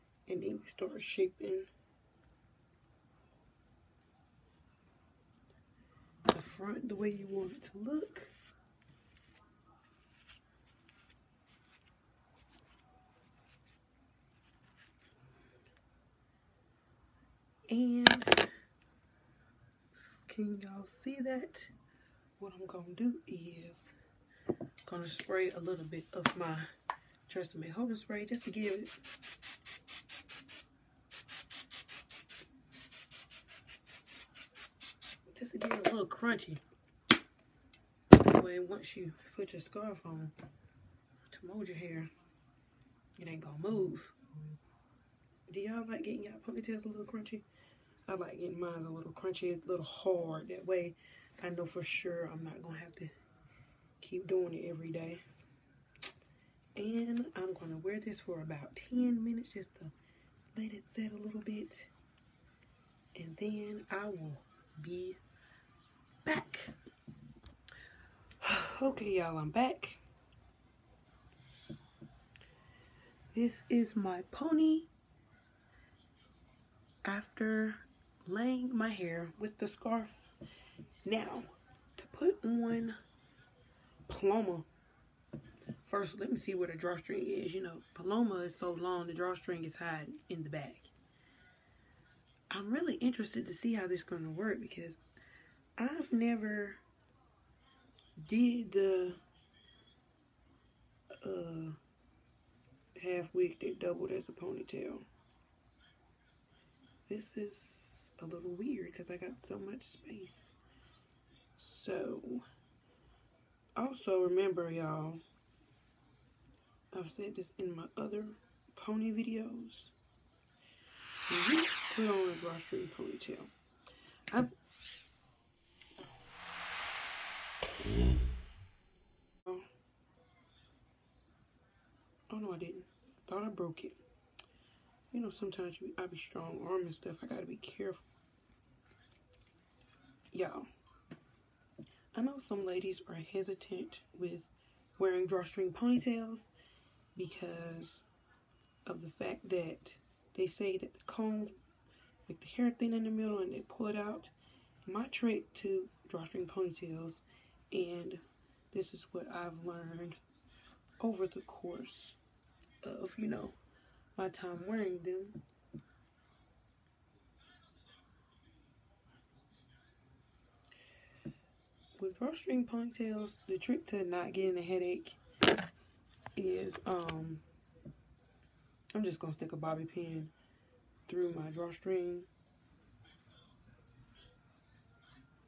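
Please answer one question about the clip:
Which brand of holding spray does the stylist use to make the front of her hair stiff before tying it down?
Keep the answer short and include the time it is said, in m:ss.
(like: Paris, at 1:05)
Tresemme, at 0:27.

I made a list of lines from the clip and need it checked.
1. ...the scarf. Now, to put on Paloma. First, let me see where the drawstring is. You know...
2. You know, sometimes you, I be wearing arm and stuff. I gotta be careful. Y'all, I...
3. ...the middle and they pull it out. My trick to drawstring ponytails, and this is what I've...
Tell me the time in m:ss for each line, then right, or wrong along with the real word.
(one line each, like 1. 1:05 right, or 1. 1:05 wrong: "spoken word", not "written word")
1. 1:19 right
2. 2:15 wrong: "strong", not "wearing"
3. 2:33 right.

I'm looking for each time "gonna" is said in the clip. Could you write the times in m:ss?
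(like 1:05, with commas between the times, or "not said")
0:22, 0:43, 0:52, 2:59.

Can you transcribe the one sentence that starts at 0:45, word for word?
Do y'all like getting y'all ponytails a little crunchy?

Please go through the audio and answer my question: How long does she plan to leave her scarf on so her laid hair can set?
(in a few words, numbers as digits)
10 minutes.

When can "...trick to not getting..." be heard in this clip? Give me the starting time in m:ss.
2:53.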